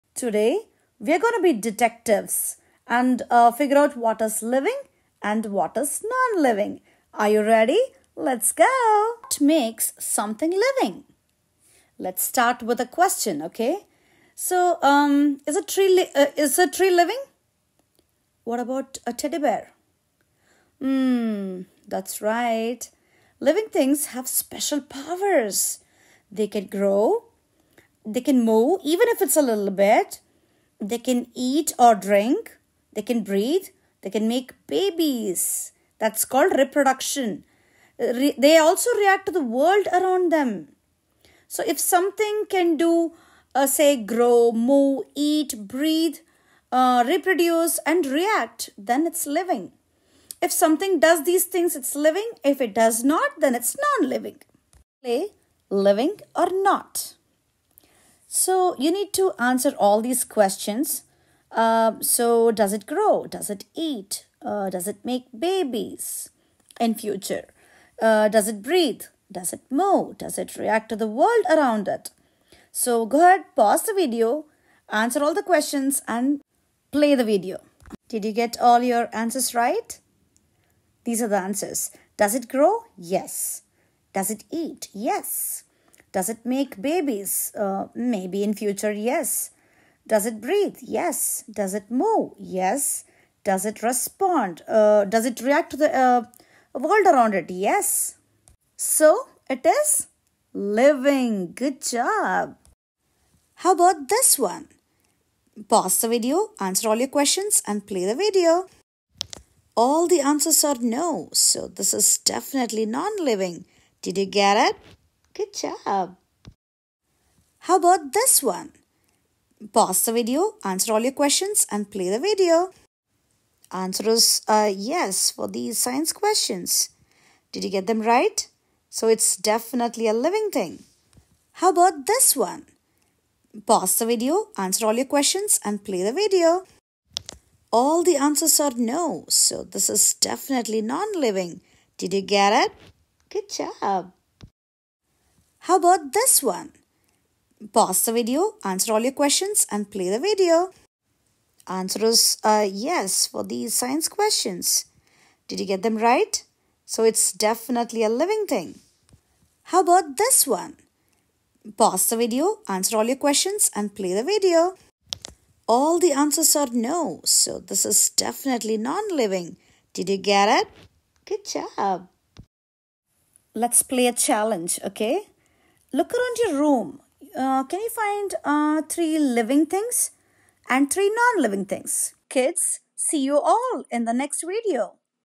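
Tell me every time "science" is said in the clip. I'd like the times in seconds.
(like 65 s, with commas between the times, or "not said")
125 s, 153 s.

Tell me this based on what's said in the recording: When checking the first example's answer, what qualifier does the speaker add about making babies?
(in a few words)
Maybe in future.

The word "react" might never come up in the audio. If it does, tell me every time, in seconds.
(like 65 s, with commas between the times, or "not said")
38 s, 48 s, 70 s, 95 s.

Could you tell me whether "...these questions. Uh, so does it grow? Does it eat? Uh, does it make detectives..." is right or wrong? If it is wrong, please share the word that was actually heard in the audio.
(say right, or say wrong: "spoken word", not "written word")
wrong: "babies", not "detectives".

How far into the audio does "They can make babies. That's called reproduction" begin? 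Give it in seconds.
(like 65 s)
34 s.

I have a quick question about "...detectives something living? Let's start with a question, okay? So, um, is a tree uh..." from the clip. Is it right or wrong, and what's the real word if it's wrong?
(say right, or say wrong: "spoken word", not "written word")
wrong: "makes", not "detectives".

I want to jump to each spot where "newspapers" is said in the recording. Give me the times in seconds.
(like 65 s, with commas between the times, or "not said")
not said.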